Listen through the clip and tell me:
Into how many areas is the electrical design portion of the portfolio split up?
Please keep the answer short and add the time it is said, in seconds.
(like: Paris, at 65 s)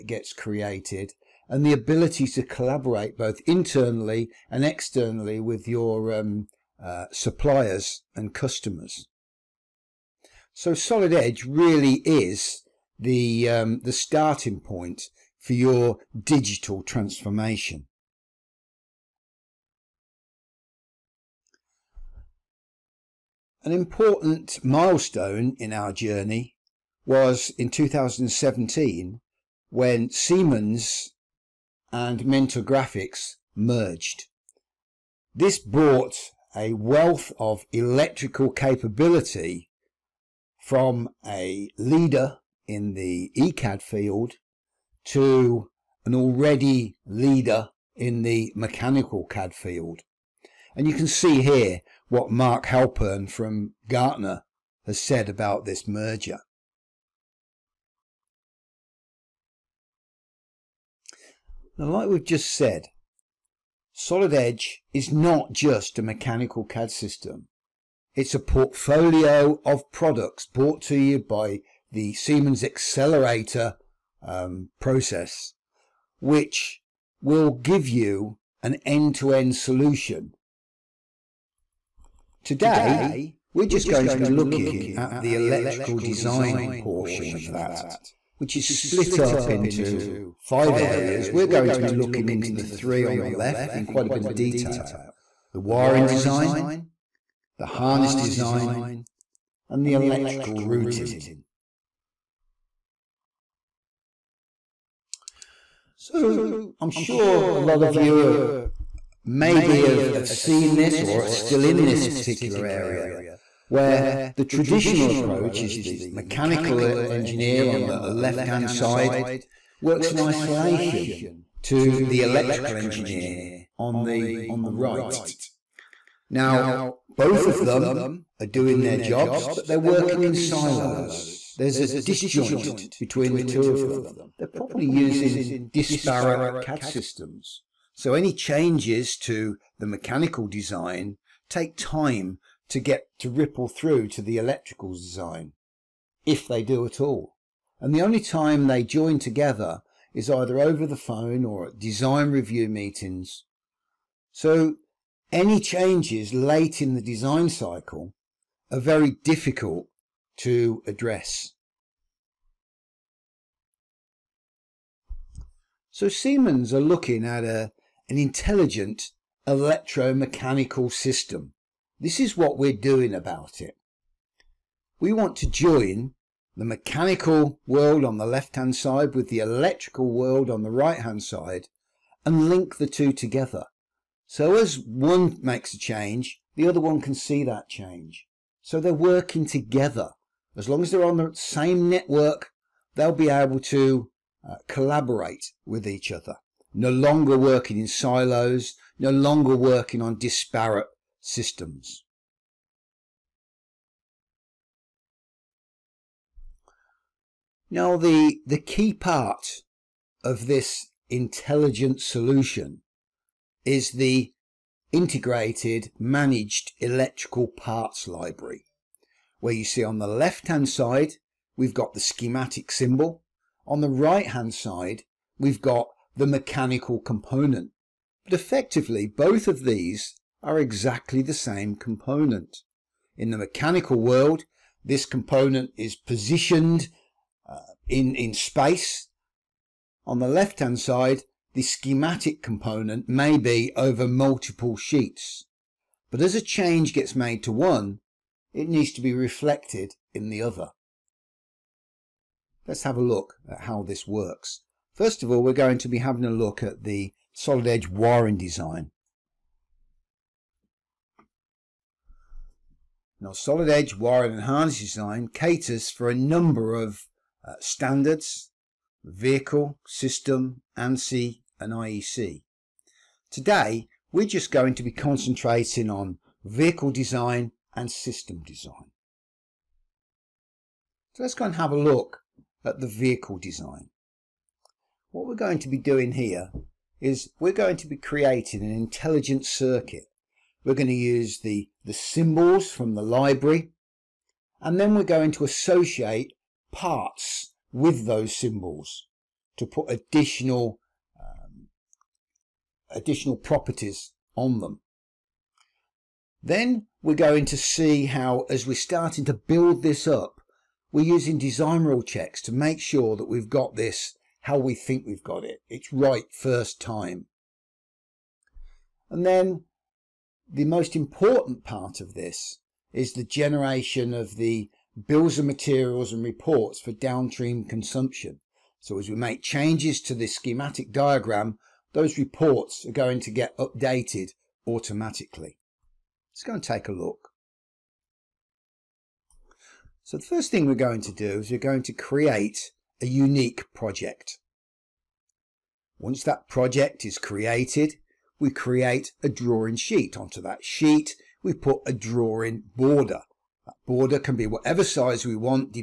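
5, at 90 s.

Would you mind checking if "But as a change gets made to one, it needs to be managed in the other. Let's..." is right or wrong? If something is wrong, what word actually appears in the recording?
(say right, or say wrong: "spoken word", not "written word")
wrong: "reflected", not "managed".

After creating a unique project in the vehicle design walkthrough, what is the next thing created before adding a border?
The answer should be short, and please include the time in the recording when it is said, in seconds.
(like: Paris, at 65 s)
a drawing sheet, at 349 s.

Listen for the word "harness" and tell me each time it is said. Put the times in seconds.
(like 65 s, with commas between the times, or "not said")
97 s, 264 s.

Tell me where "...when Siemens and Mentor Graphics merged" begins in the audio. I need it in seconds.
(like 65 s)
29 s.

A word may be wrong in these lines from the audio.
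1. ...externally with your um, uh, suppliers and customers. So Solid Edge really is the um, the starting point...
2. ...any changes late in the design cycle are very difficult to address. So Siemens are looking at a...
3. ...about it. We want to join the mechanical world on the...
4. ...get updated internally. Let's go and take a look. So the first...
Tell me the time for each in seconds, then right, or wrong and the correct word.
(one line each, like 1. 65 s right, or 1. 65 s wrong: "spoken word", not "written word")
1. 4 s right
2. 155 s right
3. 173 s right
4. 333 s wrong: "automatically", not "internally".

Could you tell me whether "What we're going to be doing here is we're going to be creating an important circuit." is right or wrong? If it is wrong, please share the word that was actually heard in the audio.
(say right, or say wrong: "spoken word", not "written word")
wrong: "intelligent", not "important".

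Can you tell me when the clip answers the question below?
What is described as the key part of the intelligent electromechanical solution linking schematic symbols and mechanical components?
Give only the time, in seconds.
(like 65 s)
214 s.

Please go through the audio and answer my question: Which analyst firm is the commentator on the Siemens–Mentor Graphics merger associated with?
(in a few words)
Gartner.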